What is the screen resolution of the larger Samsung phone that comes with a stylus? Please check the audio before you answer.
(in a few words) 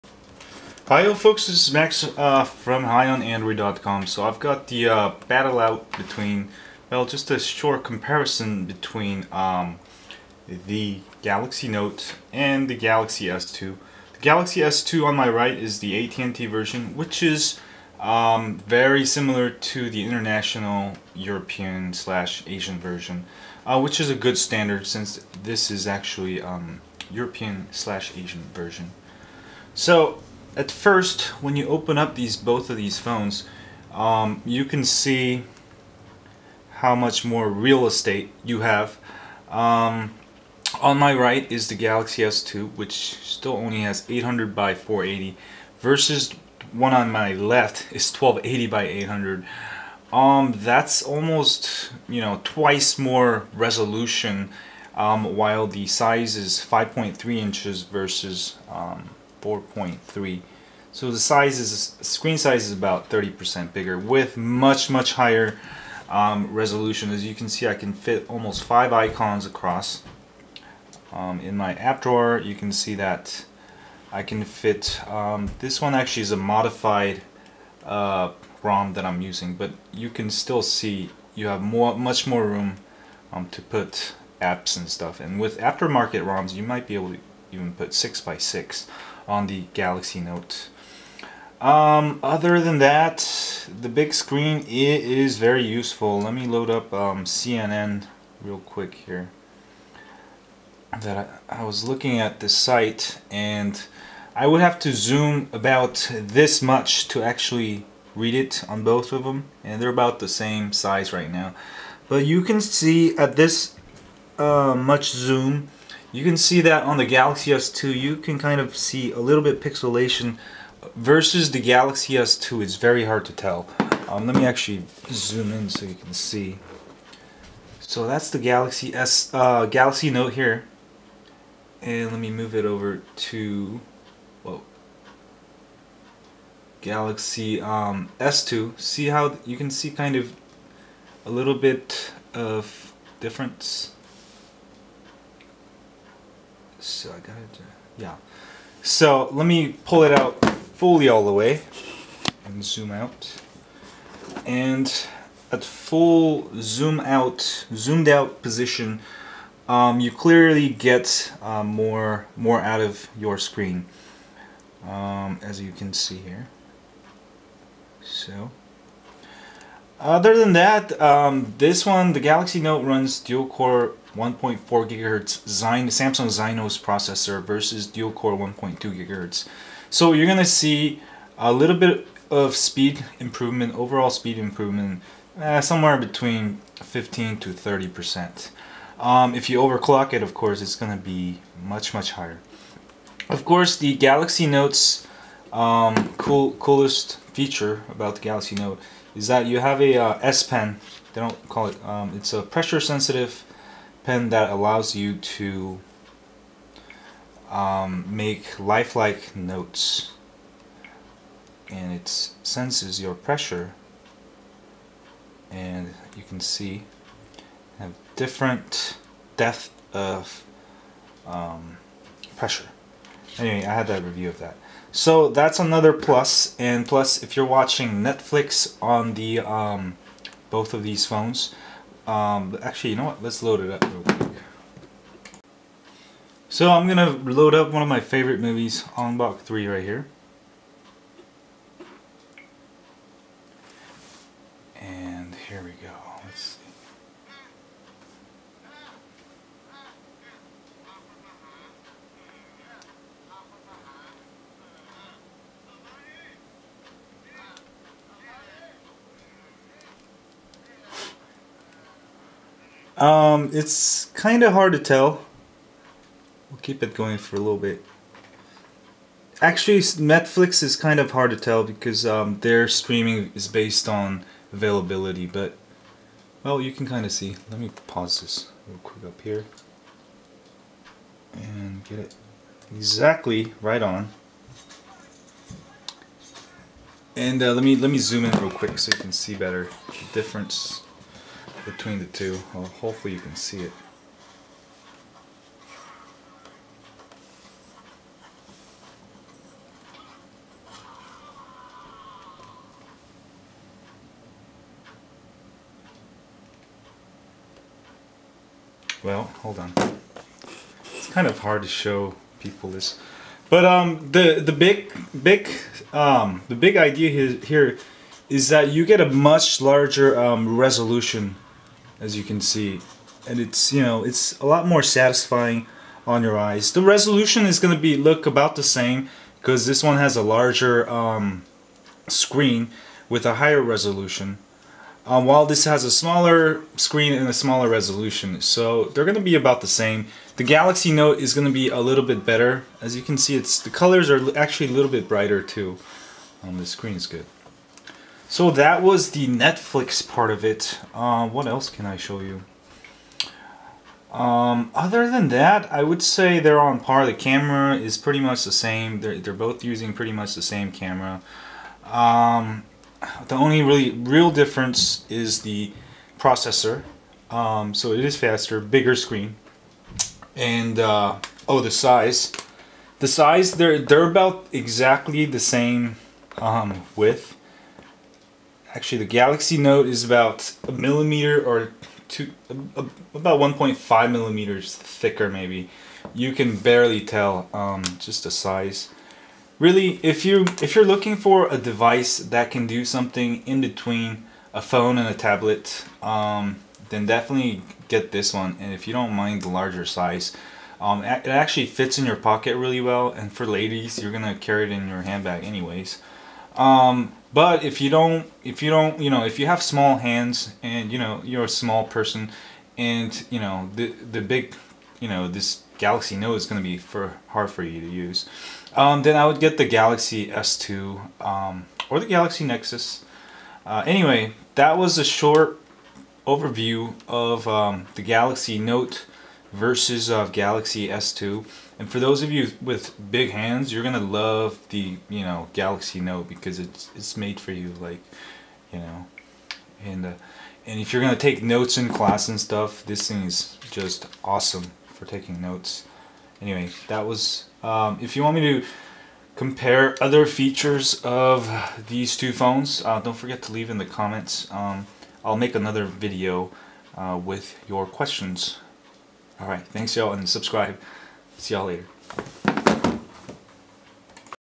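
1280 by 800.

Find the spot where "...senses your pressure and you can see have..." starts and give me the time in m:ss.
3:32.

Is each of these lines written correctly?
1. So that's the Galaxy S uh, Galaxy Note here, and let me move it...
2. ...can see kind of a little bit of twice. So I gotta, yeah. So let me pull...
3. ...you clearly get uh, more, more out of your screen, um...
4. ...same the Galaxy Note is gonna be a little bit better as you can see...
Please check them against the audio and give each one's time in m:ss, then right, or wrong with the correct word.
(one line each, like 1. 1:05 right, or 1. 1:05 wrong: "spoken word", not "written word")
1. 2:07 right
2. 2:19 wrong: "difference", not "twice"
3. 2:39 right
4. 5:39 right.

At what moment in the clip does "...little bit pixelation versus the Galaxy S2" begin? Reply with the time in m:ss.
1:59.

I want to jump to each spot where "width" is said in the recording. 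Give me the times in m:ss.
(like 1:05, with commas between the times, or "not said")
6:16.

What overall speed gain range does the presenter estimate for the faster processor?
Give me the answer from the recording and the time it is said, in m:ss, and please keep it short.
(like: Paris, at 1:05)
15 to 30 percent, at 3:06.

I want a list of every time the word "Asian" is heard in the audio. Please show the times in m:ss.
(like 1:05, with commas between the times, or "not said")
0:22, 0:28.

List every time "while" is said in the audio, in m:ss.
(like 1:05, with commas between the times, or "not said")
0:55, 5:35.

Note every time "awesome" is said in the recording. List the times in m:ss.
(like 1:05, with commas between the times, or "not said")
7:24.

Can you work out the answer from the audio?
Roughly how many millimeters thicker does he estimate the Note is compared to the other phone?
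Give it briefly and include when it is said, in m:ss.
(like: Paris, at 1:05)
1.5 millimeters, at 6:23.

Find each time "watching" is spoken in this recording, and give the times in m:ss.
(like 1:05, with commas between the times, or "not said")
3:47.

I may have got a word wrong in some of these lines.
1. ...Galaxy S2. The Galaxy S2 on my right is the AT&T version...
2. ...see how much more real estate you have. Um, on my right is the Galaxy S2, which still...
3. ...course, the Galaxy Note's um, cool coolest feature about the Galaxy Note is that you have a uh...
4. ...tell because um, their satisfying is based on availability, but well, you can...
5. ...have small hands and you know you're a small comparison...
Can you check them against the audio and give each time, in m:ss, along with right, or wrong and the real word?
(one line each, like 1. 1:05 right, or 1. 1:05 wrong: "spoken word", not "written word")
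1. 0:12 right
2. 0:34 right
3. 3:13 right
4. 4:31 wrong: "streaming", not "satisfying"
5. 6:49 wrong: "person", not "comparison".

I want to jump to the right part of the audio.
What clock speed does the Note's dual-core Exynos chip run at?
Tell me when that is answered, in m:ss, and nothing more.
2:54.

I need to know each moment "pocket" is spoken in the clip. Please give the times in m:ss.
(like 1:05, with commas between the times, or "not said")
6:42.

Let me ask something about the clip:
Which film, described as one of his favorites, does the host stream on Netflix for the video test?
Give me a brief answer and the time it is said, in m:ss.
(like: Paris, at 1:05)
Ong Bak 3, at 3:58.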